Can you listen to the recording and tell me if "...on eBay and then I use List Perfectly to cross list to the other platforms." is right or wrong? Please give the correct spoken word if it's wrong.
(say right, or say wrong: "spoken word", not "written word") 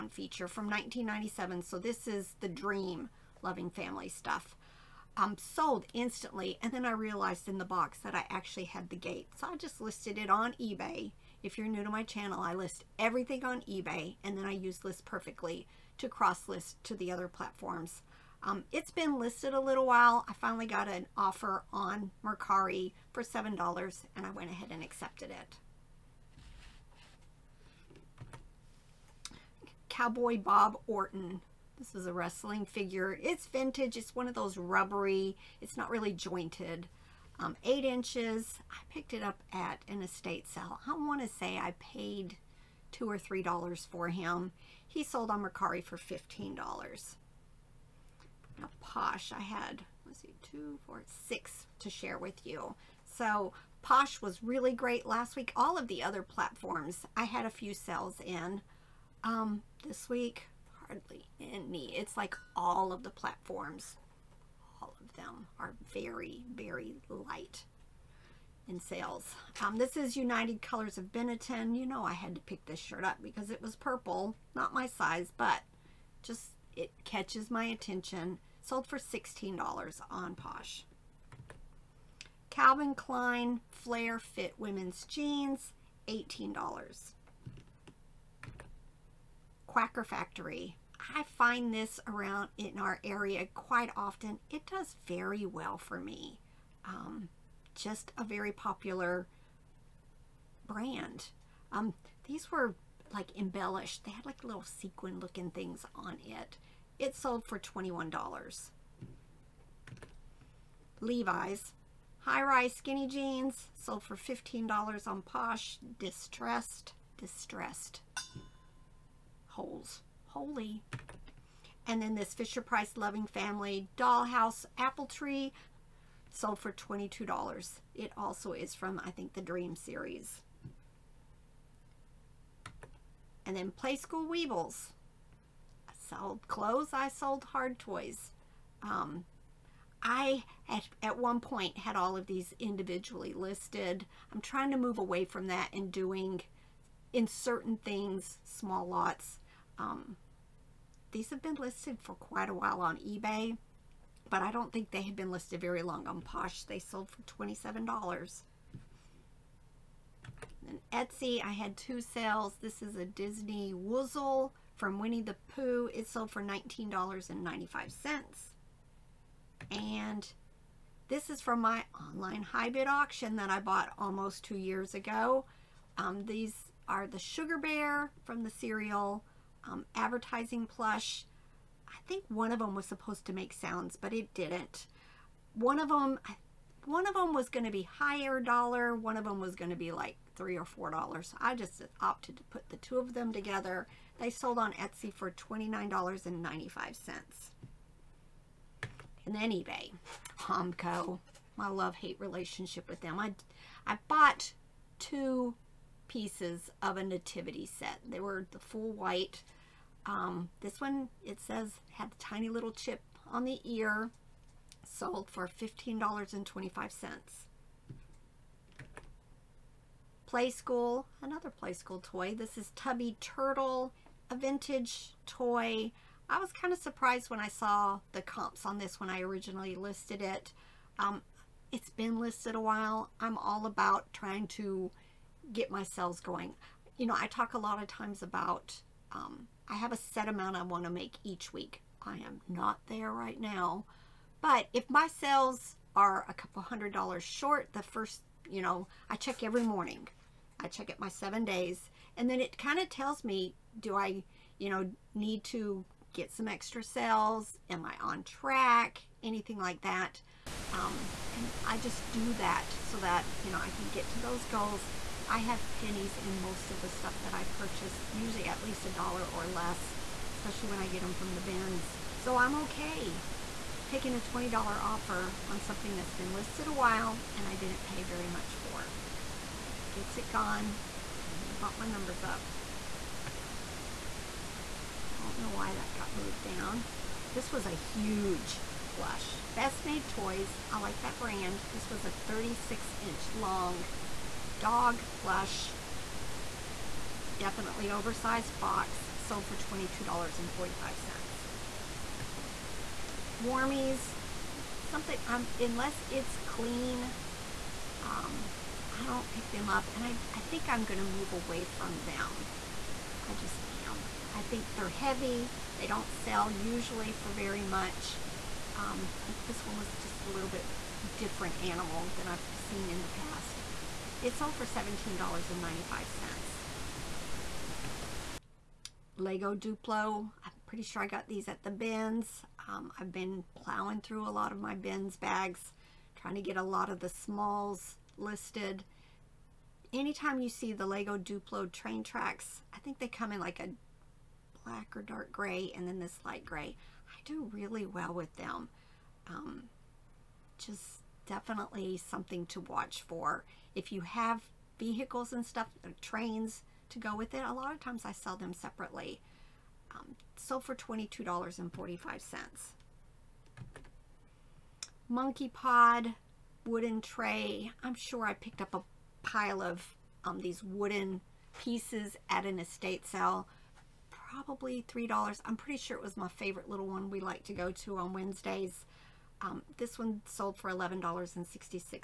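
right.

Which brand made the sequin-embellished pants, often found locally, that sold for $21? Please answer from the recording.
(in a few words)
Quacker Factory.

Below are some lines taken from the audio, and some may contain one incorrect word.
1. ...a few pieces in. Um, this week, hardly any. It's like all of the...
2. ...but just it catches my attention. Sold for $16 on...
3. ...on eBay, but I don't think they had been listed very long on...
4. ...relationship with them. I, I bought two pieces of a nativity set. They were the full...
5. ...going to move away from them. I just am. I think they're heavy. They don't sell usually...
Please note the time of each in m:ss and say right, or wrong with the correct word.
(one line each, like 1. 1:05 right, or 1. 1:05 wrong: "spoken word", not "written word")
1. 0:57 wrong: "sales", not "pieces"
2. 1:15 right
3. 2:32 right
4. 3:22 right
5. 5:10 right.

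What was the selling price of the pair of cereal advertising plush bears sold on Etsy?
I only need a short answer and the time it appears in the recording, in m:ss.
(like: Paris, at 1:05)
$29.95, at 3:15.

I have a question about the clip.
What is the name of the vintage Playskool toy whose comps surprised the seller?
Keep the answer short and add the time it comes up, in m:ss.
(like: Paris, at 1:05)
Tubby Turtle, at 3:42.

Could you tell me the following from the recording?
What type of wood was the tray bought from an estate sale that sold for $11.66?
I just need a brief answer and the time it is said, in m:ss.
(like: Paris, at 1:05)
Monkey pod, at 6:05.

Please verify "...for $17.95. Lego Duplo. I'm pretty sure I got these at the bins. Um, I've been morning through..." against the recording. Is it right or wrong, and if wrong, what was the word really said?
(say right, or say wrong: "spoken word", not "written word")
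wrong: "plowing", not "morning".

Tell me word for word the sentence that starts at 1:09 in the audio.
Um, this is United Colors of Benetton.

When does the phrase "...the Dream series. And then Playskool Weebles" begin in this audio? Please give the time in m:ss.
2:09.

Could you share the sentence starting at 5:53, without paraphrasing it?
If you have vehicles and stuff, uh, trains to go with it, a lot of times I sell them separately.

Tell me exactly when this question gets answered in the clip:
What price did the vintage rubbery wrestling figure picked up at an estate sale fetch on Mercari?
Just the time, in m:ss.
0:45.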